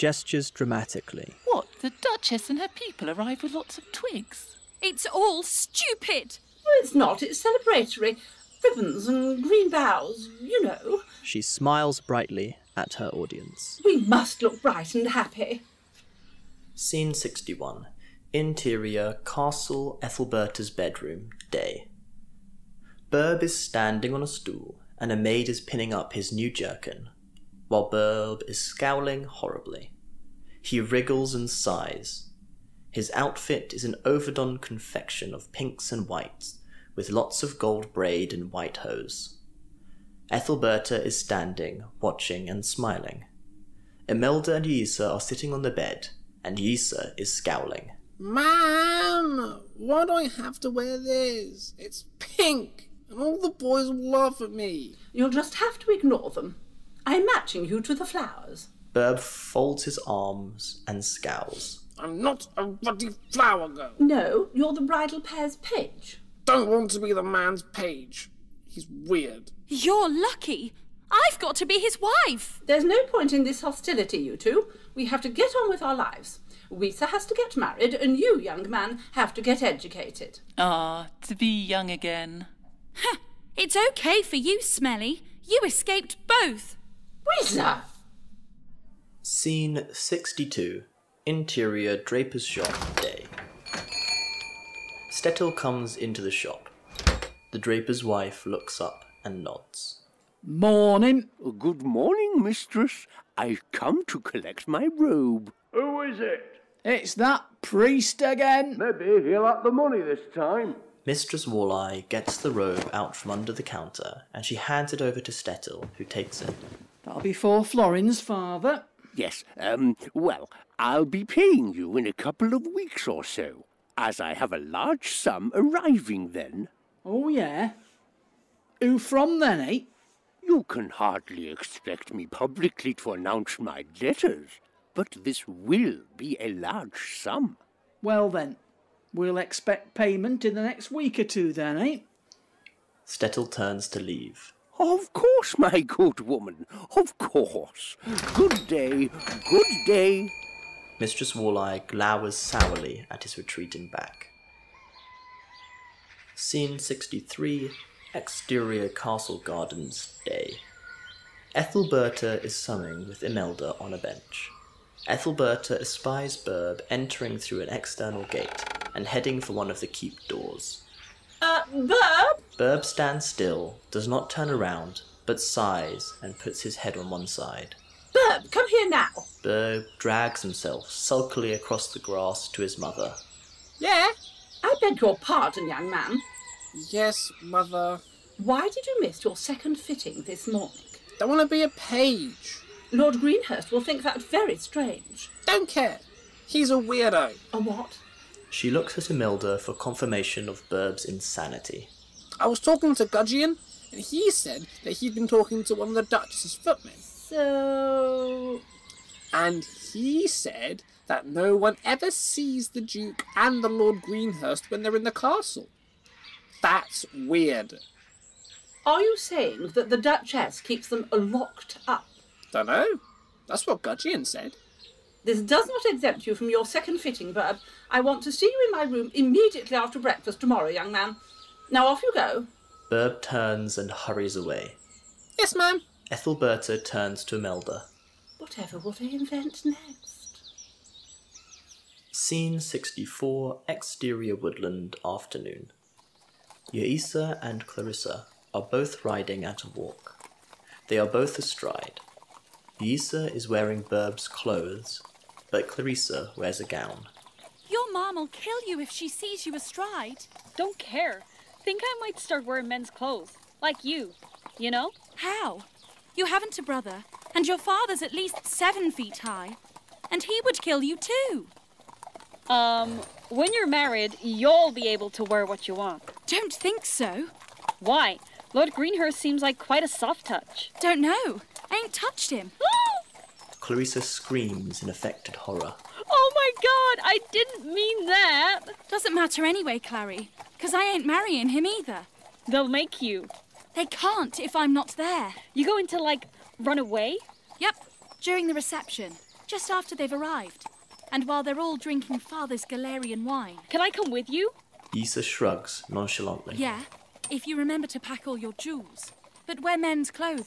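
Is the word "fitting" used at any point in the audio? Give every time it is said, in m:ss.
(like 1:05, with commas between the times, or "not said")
3:09, 3:46.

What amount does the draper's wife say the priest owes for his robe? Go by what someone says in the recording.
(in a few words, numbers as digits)
4 florins.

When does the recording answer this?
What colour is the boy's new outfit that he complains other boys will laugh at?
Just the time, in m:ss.
0:52.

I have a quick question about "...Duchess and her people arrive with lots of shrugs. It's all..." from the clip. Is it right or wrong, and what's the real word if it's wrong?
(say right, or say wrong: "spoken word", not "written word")
wrong: "twigs", not "shrugs".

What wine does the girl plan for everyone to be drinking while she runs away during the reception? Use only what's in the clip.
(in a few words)
Galarian wine.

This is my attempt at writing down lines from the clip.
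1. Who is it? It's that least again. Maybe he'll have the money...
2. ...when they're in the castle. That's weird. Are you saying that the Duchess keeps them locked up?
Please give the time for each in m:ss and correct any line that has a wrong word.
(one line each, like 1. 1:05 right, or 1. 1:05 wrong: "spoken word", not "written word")
1. 1:45 wrong: "priest", not "least"
2. 3:34 right.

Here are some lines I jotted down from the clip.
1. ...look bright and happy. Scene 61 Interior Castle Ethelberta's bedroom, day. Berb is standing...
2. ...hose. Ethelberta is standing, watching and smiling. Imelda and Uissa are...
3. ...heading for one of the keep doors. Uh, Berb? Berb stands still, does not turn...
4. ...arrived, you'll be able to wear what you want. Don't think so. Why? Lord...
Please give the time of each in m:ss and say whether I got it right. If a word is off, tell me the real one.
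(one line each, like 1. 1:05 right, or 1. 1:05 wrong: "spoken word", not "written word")
1. 0:14 right
2. 0:38 right
3. 2:49 right
4. 4:33 wrong: "married", not "arrived".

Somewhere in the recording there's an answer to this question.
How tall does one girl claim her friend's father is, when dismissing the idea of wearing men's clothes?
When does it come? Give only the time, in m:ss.
4:28.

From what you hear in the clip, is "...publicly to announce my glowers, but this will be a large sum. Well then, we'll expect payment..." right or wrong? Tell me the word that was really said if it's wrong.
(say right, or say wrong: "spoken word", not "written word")
wrong: "letters", not "glowers".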